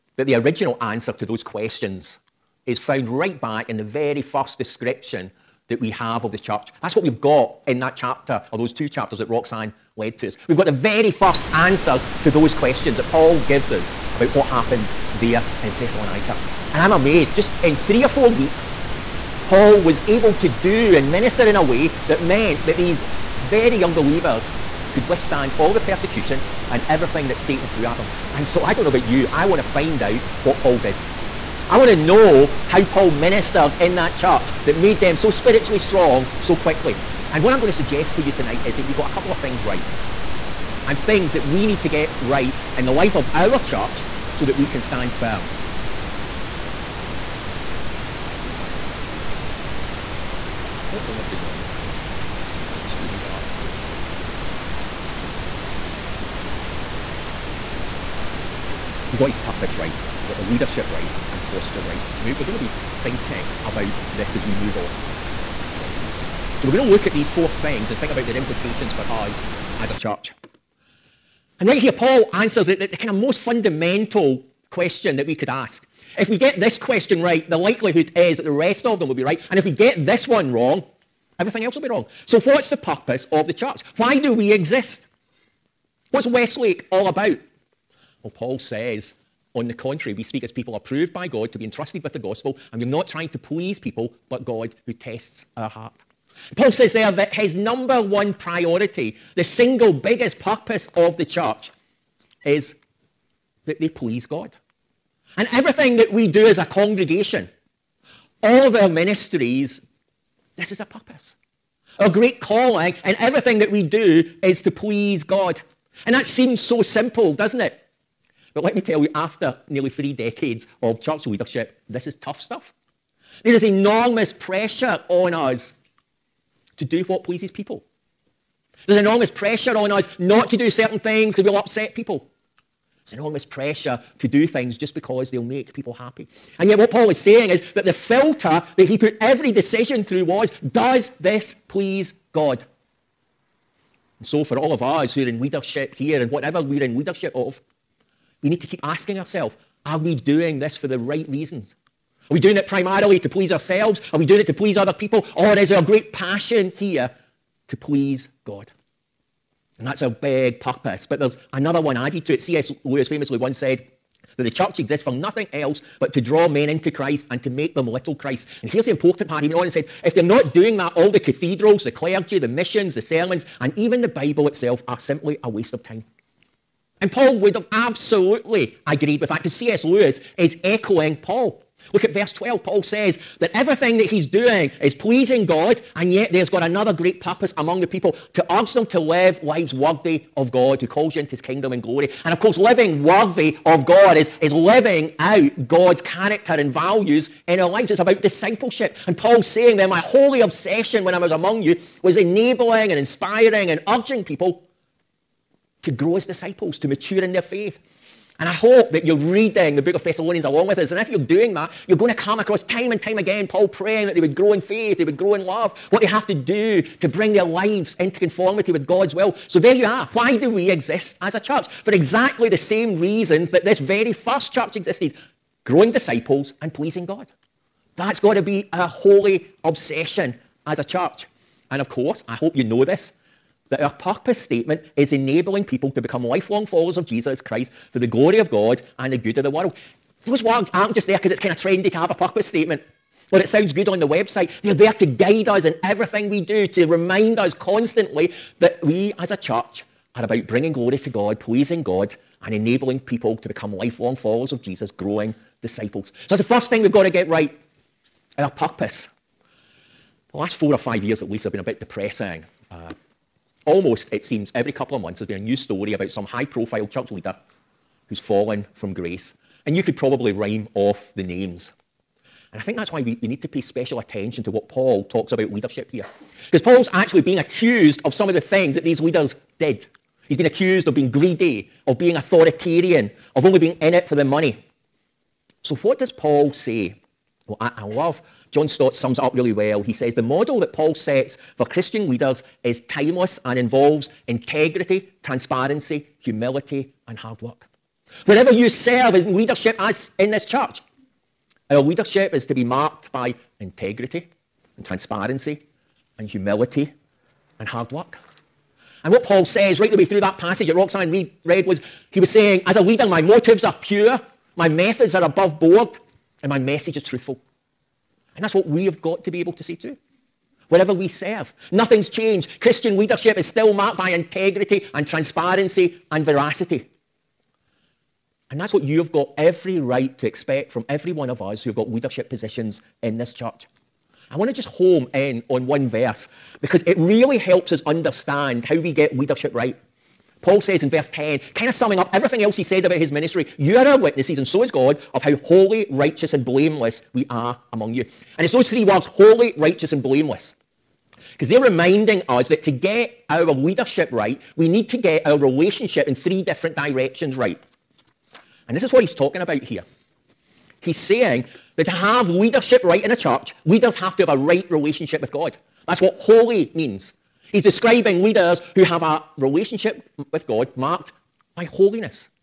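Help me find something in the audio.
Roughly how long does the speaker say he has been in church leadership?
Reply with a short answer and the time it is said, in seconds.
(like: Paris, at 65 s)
Nearly 3 decades, at 119 s.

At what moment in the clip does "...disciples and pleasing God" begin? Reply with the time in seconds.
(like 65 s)
225 s.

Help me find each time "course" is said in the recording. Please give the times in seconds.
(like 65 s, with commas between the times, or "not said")
192 s, 231 s.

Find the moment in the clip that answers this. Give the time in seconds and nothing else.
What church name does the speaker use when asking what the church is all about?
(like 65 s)
86 s.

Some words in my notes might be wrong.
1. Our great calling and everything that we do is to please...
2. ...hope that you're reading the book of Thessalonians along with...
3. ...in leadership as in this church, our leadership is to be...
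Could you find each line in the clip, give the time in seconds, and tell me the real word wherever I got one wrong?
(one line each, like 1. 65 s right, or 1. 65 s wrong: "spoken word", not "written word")
1. 111 s right
2. 208 s right
3. 299 s right.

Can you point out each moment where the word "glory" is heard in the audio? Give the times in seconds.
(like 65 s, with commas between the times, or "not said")
191 s, 238 s, 250 s.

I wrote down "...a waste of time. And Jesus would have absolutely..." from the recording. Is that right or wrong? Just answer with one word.
wrong.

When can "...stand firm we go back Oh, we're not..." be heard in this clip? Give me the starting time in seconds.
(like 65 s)
44 s.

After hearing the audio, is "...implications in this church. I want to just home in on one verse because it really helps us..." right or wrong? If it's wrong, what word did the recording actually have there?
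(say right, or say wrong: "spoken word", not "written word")
wrong: "positions", not "implications".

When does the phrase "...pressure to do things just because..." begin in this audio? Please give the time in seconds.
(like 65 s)
133 s.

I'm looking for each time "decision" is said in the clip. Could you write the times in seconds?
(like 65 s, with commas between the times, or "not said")
139 s.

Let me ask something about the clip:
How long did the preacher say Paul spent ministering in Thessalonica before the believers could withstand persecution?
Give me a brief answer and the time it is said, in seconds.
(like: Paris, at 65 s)
3 or 4 weeks, at 17 s.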